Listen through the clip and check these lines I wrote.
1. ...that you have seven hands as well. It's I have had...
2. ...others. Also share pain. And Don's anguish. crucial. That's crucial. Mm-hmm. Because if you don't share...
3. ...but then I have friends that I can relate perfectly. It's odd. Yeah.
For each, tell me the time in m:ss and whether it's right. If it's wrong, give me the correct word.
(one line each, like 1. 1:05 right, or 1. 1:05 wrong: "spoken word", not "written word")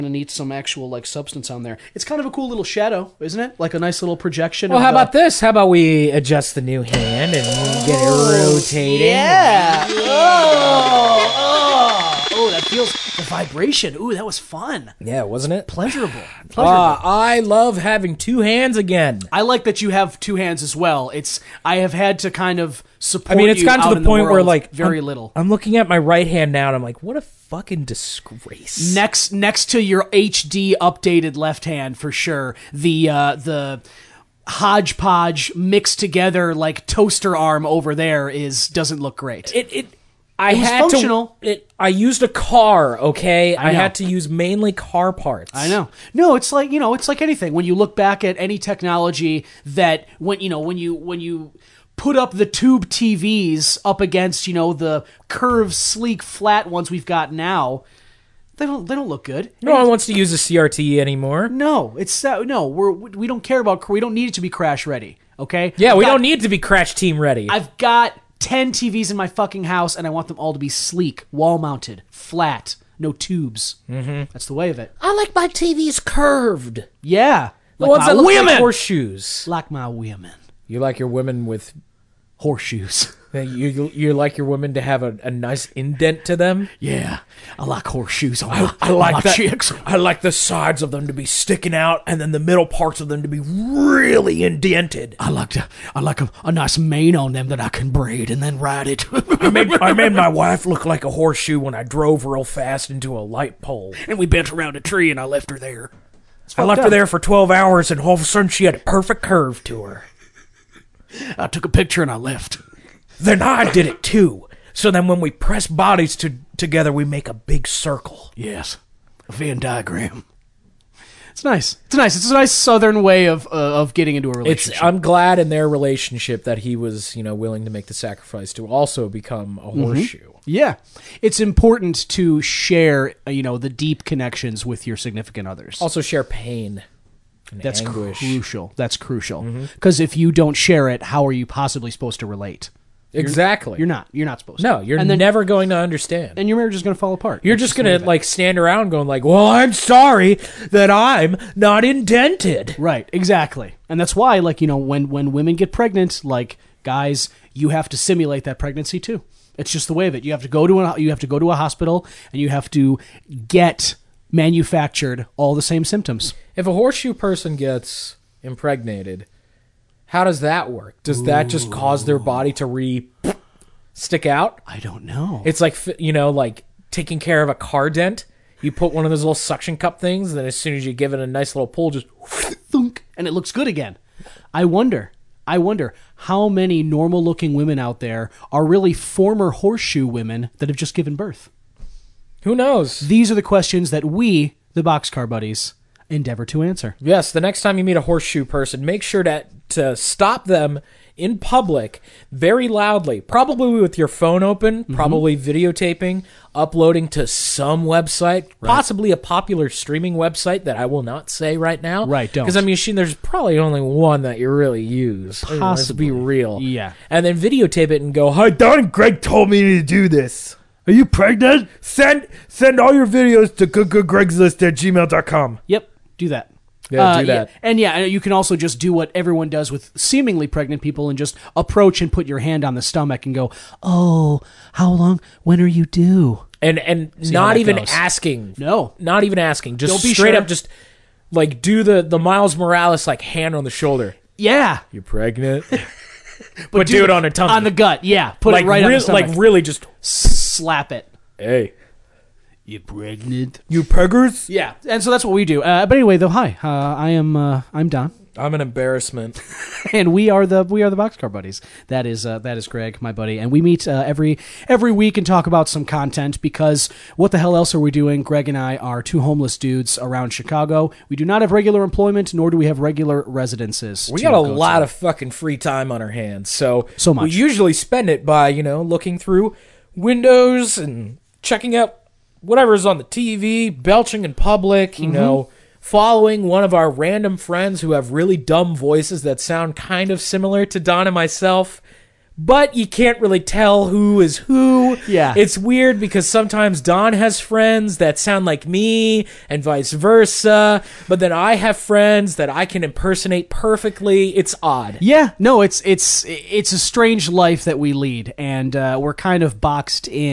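1. 0:19 wrong: "two", not "seven"
2. 2:15 wrong: "That", not "Don"
3. 5:01 wrong: "impersonate", not "relate".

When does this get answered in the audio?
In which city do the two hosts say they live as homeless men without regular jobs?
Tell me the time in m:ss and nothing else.
4:30.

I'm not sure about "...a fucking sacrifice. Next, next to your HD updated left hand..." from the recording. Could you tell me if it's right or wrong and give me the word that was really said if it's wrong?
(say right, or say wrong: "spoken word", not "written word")
wrong: "disgrace", not "sacrifice".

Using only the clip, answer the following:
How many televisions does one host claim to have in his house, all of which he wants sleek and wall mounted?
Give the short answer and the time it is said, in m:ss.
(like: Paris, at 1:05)
10, at 1:08.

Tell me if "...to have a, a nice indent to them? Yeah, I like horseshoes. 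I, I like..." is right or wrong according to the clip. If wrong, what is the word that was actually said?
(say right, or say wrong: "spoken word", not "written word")
right.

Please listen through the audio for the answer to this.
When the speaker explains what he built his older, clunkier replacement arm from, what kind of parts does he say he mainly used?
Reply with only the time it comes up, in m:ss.
0:44.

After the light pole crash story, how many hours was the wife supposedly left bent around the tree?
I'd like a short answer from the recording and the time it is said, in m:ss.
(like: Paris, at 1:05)
12, at 1:47.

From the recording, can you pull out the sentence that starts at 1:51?
I took a picture and I left.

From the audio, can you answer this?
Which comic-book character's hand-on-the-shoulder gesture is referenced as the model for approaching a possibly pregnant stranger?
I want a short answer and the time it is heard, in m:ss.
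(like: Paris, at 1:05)
Miles Morales, at 4:02.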